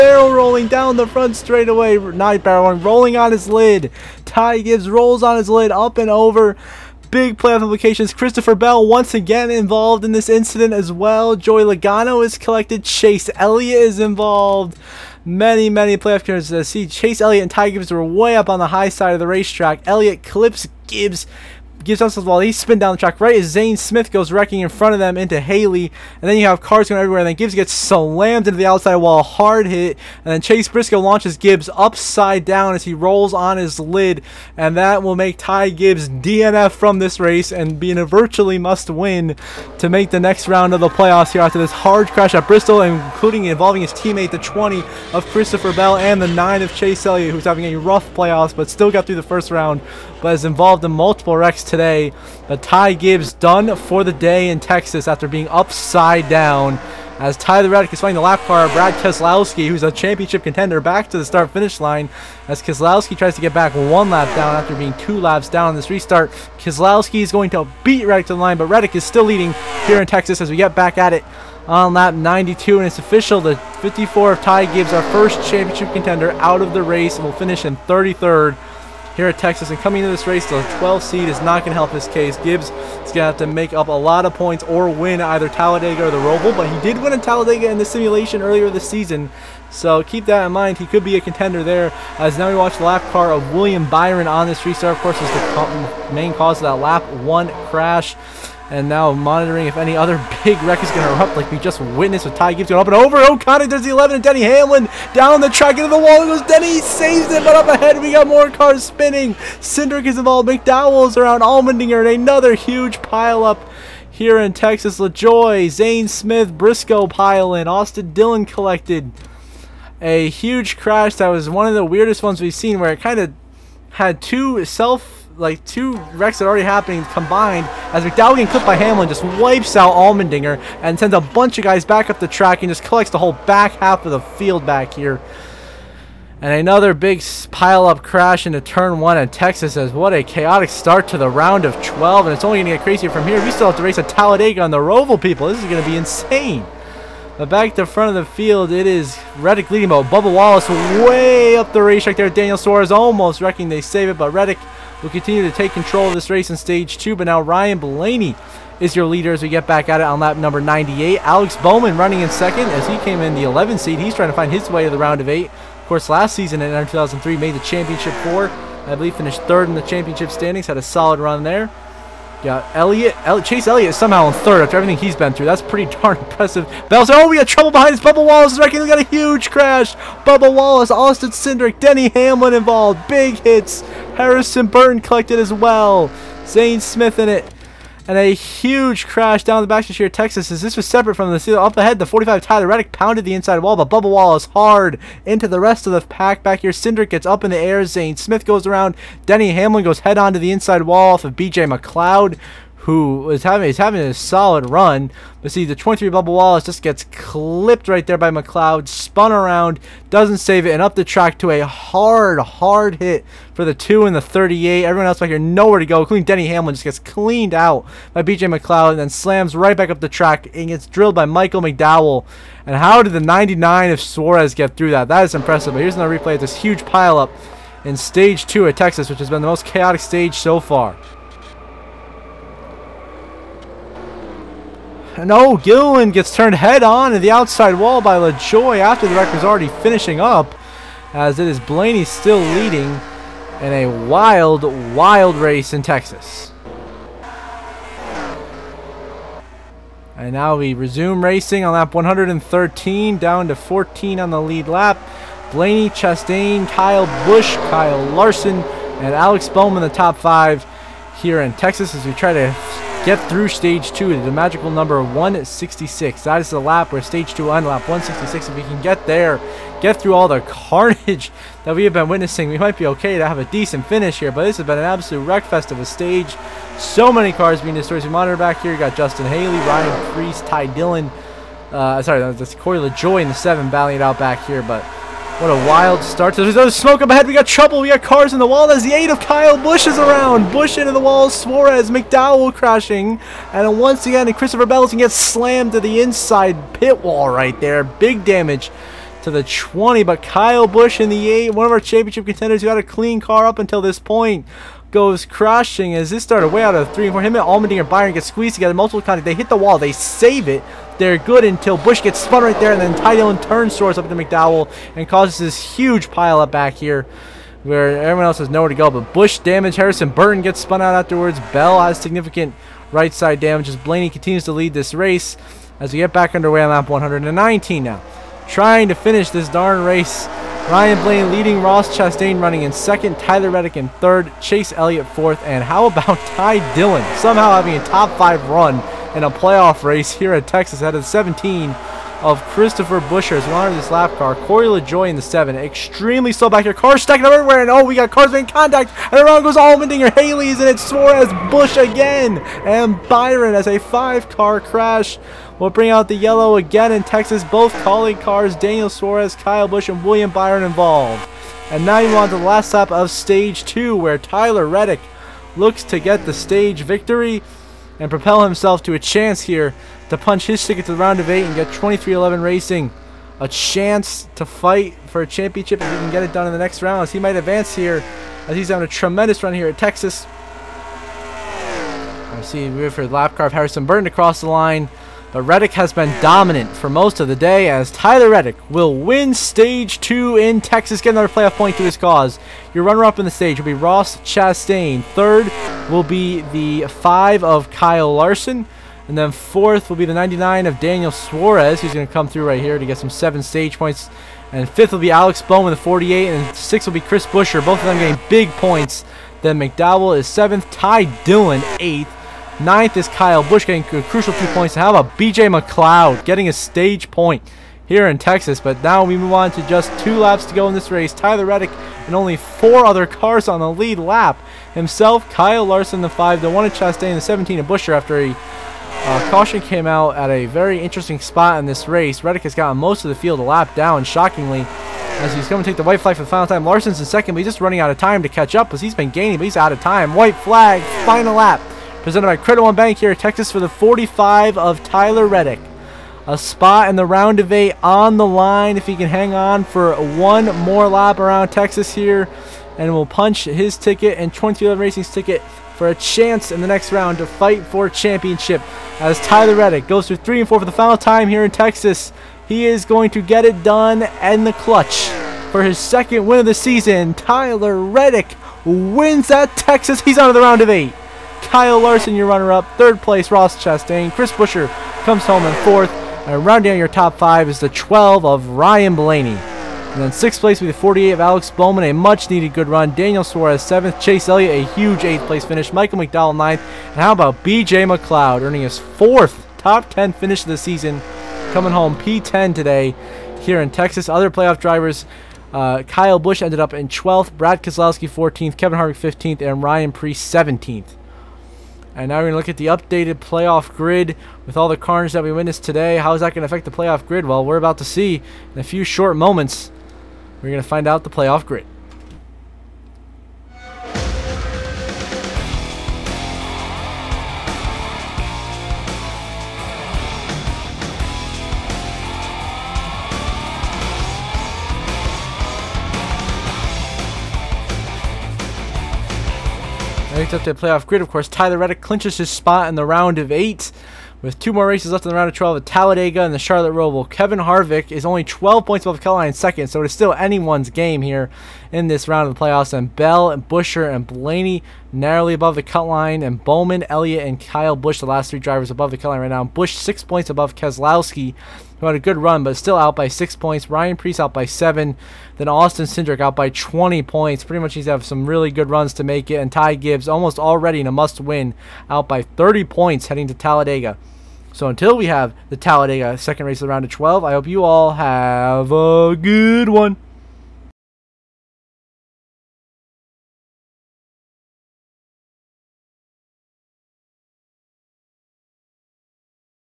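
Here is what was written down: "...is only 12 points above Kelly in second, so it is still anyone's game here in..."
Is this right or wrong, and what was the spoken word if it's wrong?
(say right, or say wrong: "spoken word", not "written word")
right.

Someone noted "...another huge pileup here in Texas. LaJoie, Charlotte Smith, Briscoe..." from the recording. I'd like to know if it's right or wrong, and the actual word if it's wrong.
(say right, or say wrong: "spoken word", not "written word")
wrong: "Zane", not "Charlotte".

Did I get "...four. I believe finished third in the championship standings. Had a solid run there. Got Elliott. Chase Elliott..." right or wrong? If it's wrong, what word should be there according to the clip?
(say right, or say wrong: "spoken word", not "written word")
right.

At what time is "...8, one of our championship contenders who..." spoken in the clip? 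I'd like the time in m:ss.
5:01.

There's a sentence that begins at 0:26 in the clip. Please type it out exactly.
And then you have cars going everywhere.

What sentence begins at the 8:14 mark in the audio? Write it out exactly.
Other playoff drivers uh, Kyle Busch ended up in 12th, Brad Keselowski 14th, Kevin Harvick 15th, and Ryan Priest 17th.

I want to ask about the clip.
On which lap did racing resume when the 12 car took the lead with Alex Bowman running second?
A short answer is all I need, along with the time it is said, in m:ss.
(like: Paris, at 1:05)
98, at 2:40.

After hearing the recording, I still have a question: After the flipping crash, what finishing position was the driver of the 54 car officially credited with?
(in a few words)
33rd.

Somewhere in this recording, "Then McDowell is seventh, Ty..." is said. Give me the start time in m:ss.
6:49.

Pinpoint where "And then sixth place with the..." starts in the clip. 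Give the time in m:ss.
7:59.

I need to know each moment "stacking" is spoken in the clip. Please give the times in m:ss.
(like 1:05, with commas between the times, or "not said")
5:47.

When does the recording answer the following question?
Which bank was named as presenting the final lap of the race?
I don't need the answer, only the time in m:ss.
7:22.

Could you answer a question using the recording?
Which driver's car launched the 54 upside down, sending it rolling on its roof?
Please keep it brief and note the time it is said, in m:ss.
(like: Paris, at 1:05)
Chase Briscoe, at 0:30.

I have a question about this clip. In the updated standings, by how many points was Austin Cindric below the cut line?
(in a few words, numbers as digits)
20.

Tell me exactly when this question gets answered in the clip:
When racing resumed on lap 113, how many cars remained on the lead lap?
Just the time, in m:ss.
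4:13.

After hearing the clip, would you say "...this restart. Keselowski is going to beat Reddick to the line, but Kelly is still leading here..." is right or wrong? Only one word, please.
wrong.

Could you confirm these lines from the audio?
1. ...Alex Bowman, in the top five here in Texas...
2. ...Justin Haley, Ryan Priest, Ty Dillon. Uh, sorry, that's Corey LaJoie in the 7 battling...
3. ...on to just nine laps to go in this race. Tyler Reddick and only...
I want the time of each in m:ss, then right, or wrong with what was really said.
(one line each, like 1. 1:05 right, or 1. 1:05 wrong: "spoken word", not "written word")
1. 4:19 right
2. 4:38 right
3. 6:59 wrong: "two", not "nine".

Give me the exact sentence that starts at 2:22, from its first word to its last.
And it's only going to get crazier from here.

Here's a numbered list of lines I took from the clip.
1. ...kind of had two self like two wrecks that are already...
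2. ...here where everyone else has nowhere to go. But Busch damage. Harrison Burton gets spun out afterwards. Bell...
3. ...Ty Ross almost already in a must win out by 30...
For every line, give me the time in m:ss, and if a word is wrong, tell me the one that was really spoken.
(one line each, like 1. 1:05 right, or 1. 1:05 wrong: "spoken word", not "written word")
1. 2:03 right
2. 5:16 right
3. 9:19 wrong: "Gibbs", not "Ross".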